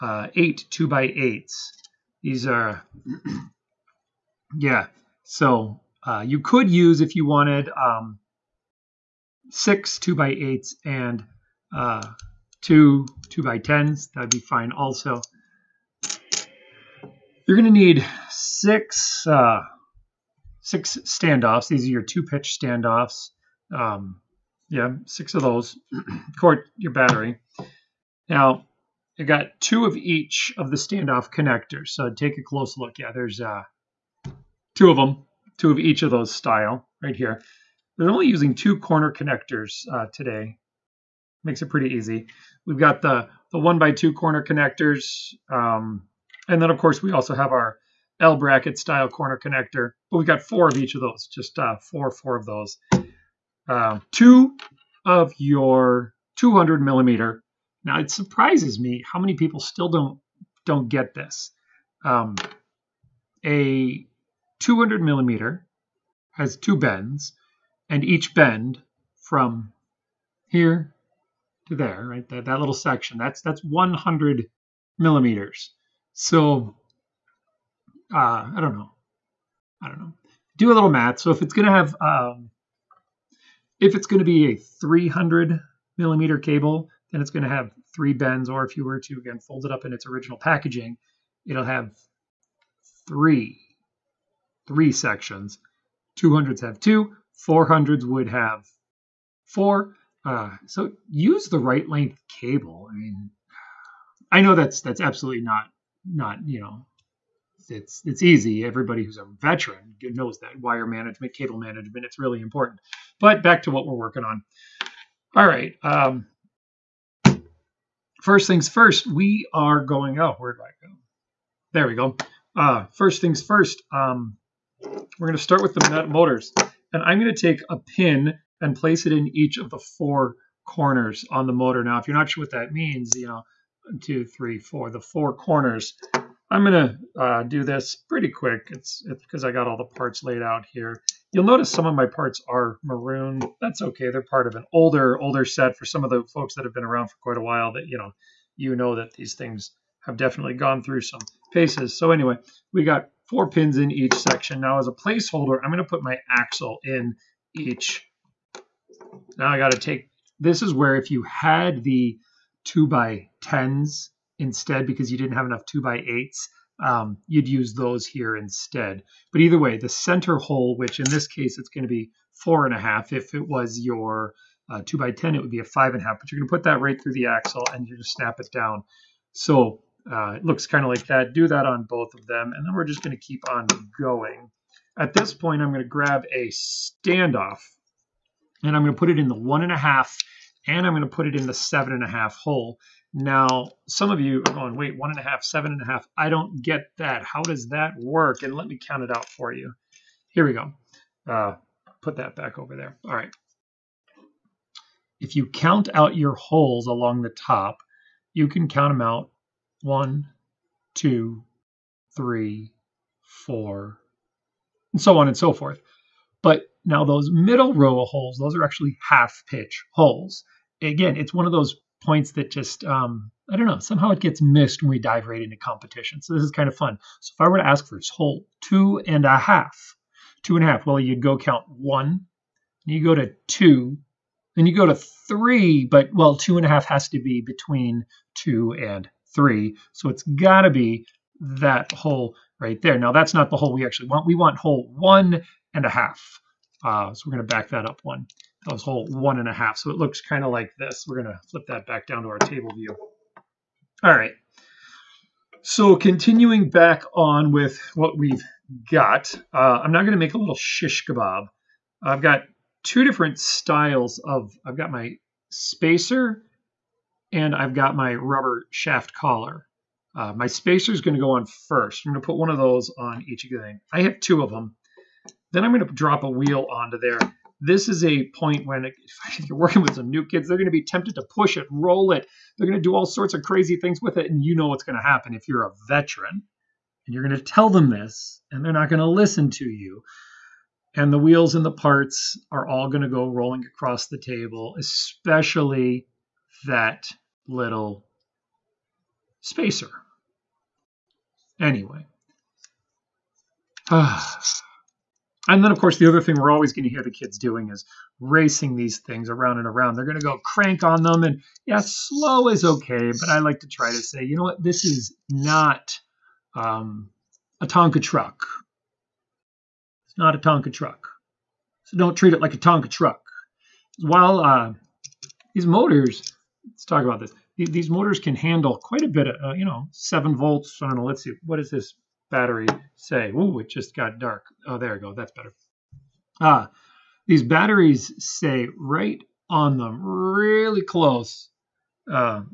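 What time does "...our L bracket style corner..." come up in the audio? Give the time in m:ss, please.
0:47.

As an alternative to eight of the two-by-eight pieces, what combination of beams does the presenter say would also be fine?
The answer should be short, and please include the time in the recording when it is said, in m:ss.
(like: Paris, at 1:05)
6 two by eights and 2 two by tens, at 0:09.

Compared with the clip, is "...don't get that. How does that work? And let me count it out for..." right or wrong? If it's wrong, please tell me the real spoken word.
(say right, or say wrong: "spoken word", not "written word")
right.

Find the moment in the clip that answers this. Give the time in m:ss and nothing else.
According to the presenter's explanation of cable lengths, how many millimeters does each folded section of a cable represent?
1:13.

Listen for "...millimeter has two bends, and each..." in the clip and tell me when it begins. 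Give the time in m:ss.
1:05.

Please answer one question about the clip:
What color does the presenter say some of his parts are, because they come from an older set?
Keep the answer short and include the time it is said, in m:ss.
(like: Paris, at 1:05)
Maroon, at 2:22.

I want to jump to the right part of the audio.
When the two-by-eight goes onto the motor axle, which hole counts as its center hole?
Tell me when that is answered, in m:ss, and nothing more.
2:52.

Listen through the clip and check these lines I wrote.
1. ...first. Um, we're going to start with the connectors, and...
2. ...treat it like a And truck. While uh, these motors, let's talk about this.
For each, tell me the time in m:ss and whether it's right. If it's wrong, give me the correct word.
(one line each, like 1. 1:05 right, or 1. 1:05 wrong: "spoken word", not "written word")
1. 2:03 wrong: "motors", not "connectors"
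2. 5:22 wrong: "Tonka", not "And".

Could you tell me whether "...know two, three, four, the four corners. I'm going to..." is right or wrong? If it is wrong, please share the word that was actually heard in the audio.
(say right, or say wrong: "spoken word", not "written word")
right.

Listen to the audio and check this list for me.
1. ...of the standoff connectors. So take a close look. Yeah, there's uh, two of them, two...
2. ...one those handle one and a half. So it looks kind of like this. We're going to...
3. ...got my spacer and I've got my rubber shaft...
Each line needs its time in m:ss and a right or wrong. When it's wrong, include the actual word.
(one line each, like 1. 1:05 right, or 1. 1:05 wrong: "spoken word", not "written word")
1. 0:30 right
2. 4:08 wrong: "whole", not "handle"
3. 4:24 right.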